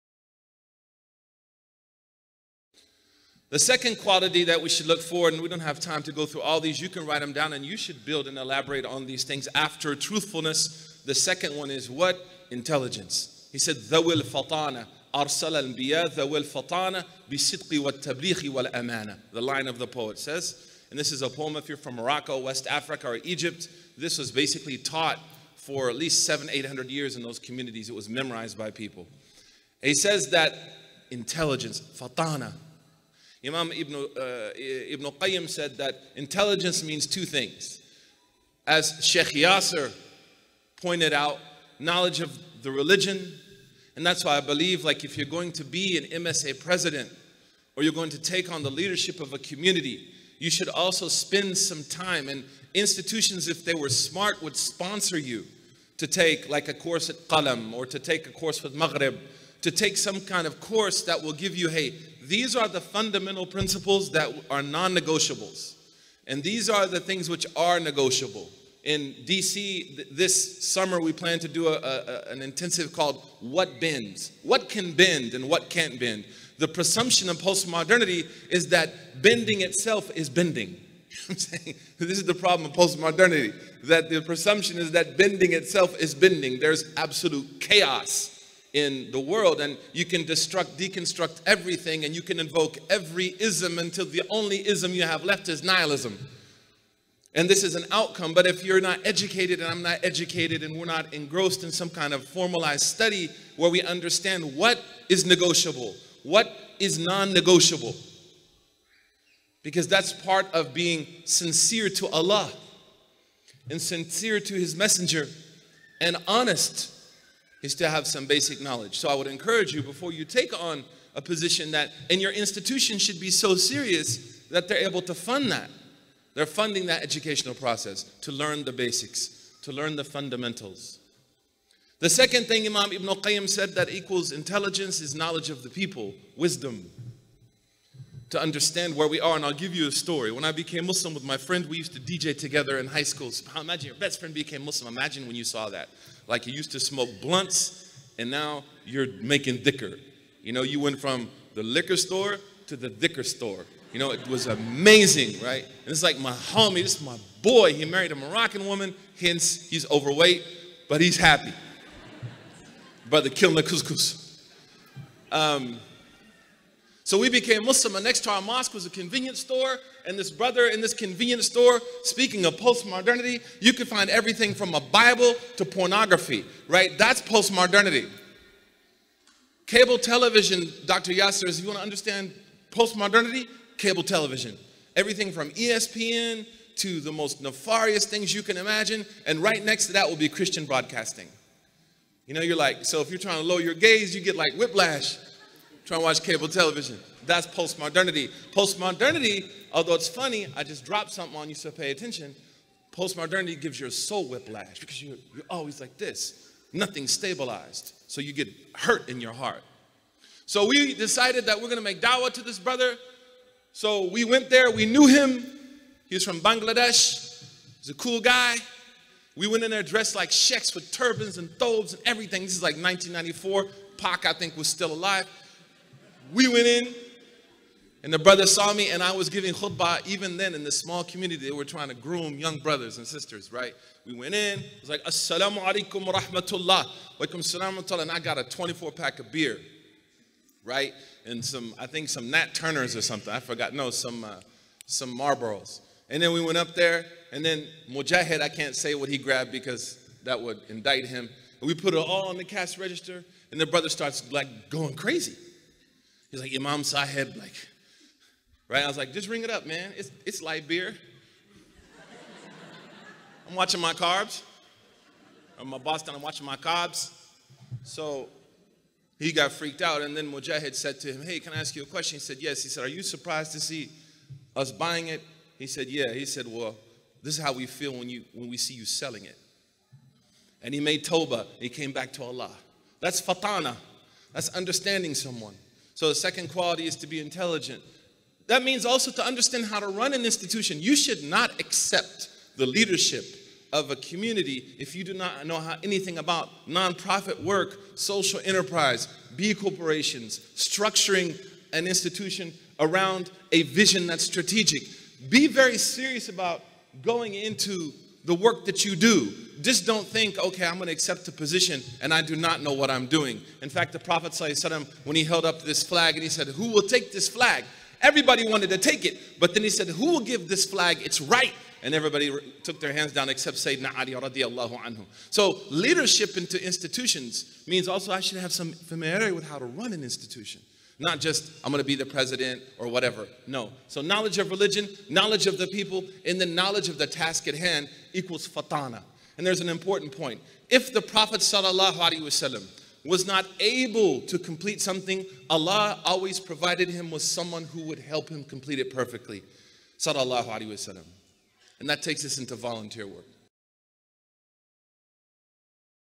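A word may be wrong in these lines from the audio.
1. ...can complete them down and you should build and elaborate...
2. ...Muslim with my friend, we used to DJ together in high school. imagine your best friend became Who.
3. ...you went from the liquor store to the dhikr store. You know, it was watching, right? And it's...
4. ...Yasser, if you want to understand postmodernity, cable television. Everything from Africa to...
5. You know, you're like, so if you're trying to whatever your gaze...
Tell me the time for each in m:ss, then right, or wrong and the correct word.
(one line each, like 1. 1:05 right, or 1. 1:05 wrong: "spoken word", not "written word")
1. 0:06 wrong: "write", not "complete"
2. 2:20 wrong: "Muslim", not "Who"
3. 2:30 wrong: "amazing", not "watching"
4. 3:01 wrong: "ESPN", not "Africa"
5. 3:12 wrong: "lower", not "whatever".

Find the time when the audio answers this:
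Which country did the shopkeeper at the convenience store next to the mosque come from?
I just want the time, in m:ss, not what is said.
3:36.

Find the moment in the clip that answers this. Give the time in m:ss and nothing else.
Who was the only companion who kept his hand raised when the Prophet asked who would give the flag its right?
5:23.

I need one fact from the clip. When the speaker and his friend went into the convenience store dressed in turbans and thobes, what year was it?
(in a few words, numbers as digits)
1994.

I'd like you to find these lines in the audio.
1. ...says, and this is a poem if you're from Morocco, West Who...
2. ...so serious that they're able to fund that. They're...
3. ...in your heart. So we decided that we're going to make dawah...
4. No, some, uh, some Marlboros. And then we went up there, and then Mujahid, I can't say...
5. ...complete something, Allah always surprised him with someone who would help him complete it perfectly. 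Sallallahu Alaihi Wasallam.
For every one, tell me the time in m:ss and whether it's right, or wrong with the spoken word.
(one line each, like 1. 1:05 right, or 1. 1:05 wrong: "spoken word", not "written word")
1. 0:20 wrong: "Africa", not "Who"
2. 2:03 right
3. 3:29 right
4. 4:03 right
5. 5:44 wrong: "provided", not "surprised".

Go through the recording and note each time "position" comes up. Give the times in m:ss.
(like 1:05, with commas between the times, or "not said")
2:01, 5:11.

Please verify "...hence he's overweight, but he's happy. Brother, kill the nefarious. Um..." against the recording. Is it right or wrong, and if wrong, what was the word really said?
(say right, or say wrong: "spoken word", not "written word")
wrong: "couscous", not "nefarious".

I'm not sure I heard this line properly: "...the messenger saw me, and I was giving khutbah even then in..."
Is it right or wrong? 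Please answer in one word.
wrong.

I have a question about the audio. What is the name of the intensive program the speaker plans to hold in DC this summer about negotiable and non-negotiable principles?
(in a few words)
What Bends?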